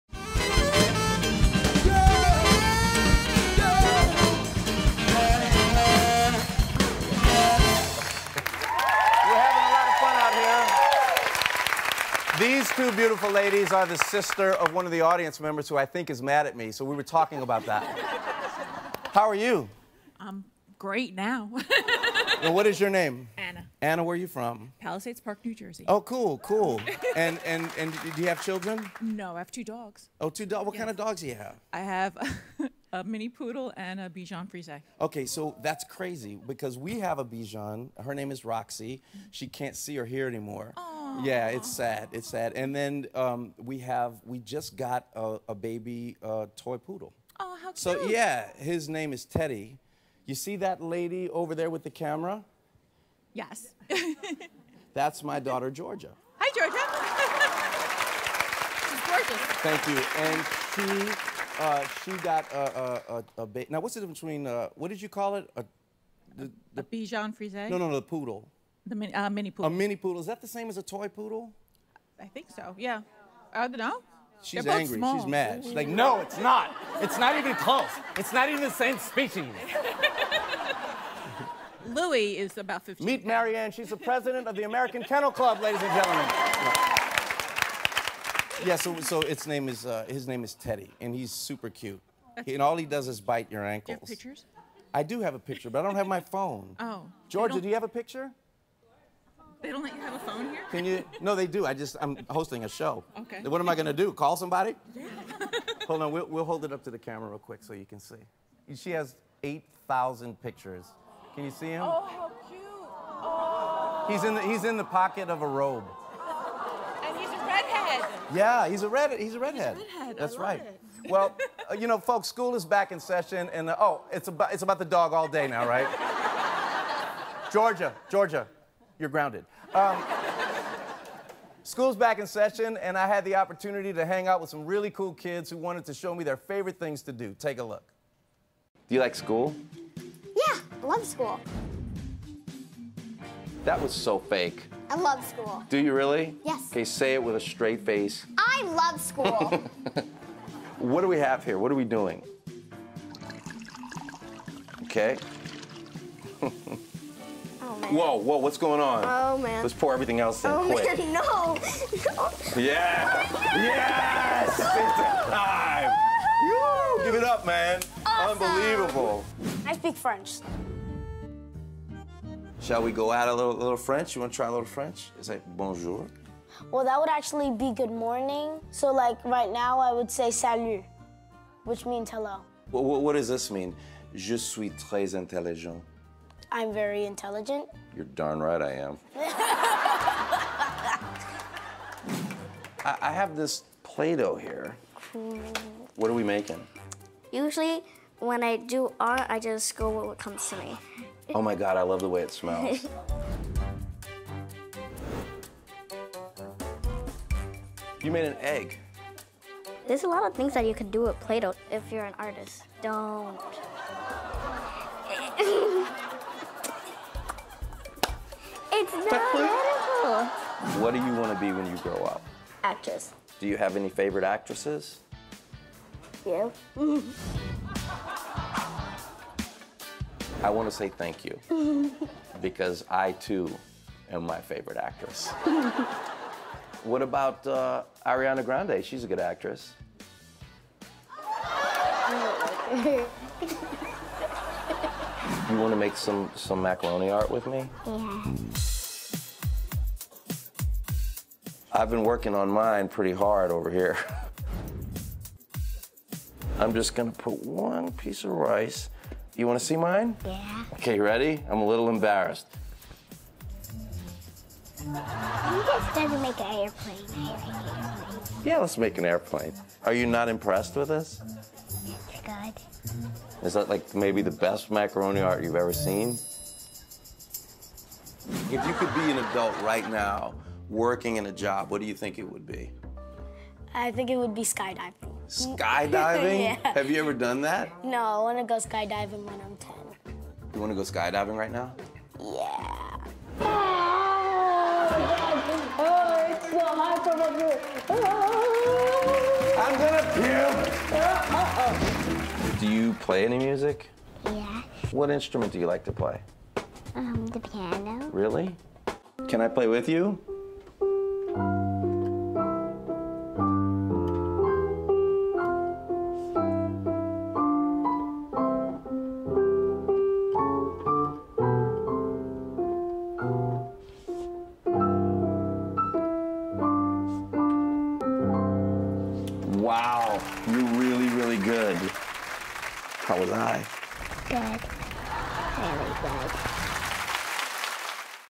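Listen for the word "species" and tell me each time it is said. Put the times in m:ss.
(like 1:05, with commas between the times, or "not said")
1:18.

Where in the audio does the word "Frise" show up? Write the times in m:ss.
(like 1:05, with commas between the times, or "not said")
0:34, 1:07.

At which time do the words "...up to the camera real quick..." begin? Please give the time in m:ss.
1:46.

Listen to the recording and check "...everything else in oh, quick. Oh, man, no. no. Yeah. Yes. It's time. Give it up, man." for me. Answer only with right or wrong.
right.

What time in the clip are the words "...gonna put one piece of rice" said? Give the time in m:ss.
4:16.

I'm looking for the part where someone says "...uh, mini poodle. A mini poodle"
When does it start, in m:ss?
1:09.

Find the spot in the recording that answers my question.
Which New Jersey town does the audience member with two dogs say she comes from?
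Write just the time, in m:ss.
0:24.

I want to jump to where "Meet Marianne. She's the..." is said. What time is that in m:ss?
1:23.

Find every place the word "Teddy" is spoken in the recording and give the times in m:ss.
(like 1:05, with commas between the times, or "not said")
0:49, 1:30.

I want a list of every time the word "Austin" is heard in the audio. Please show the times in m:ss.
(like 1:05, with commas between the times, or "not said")
not said.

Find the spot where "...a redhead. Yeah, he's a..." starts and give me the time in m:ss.
1:57.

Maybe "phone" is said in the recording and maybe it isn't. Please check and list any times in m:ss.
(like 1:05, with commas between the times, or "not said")
1:36, 1:40.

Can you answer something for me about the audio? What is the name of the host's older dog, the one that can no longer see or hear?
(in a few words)
Roxy.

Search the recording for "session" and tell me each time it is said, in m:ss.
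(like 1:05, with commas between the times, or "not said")
2:02, 2:12.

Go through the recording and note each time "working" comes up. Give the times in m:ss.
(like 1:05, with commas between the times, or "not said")
4:12, 4:40.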